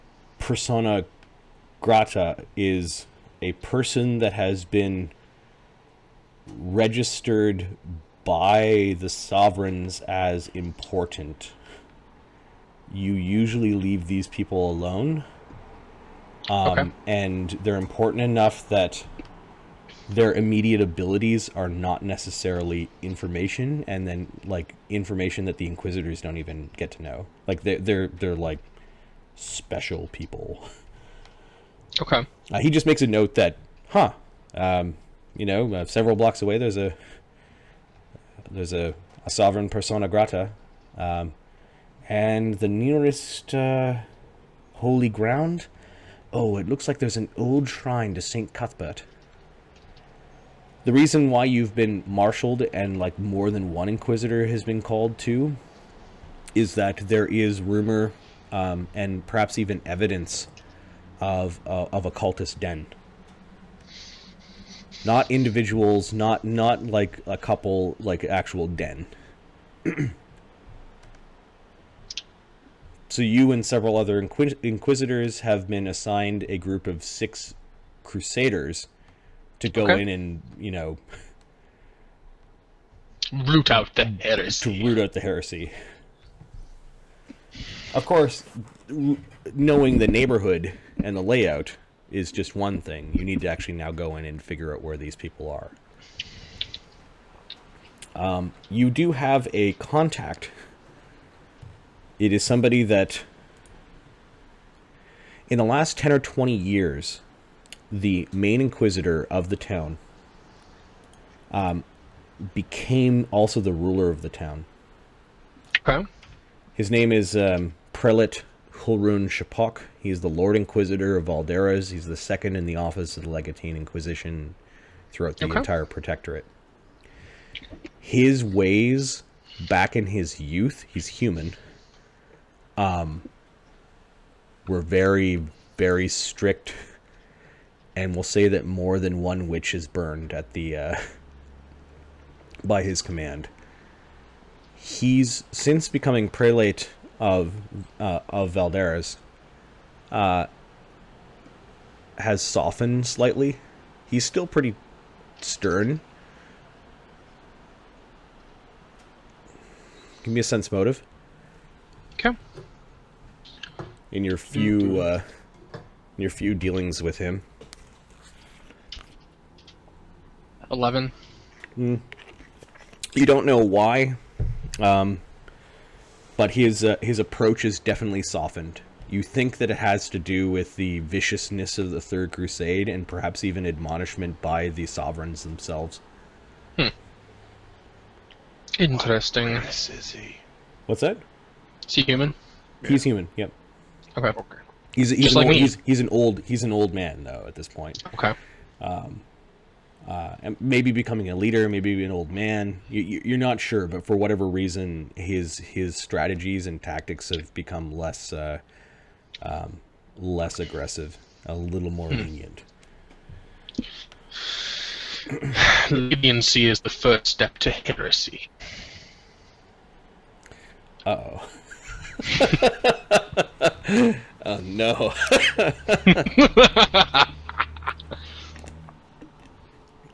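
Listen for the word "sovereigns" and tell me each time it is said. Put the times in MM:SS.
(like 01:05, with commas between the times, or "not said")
00:09, 00:39, 03:04.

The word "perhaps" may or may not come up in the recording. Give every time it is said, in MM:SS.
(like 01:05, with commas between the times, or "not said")
00:59, 03:03.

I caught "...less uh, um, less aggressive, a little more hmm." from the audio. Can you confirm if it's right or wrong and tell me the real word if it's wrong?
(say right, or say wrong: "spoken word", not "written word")
right.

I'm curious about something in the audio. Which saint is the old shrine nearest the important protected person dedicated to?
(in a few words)
Saint Cuthbert.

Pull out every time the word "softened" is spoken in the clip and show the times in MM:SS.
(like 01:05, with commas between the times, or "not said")
02:32, 02:58.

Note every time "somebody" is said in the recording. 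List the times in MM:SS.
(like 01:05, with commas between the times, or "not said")
01:42.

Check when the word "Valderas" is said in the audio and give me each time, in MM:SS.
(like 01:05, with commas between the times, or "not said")
02:01, 02:28.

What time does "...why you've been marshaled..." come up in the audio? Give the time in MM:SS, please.
00:51.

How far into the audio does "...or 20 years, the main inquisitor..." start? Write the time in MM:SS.
01:46.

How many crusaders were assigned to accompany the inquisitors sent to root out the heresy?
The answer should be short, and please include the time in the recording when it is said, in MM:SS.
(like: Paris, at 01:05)
6, at 01:17.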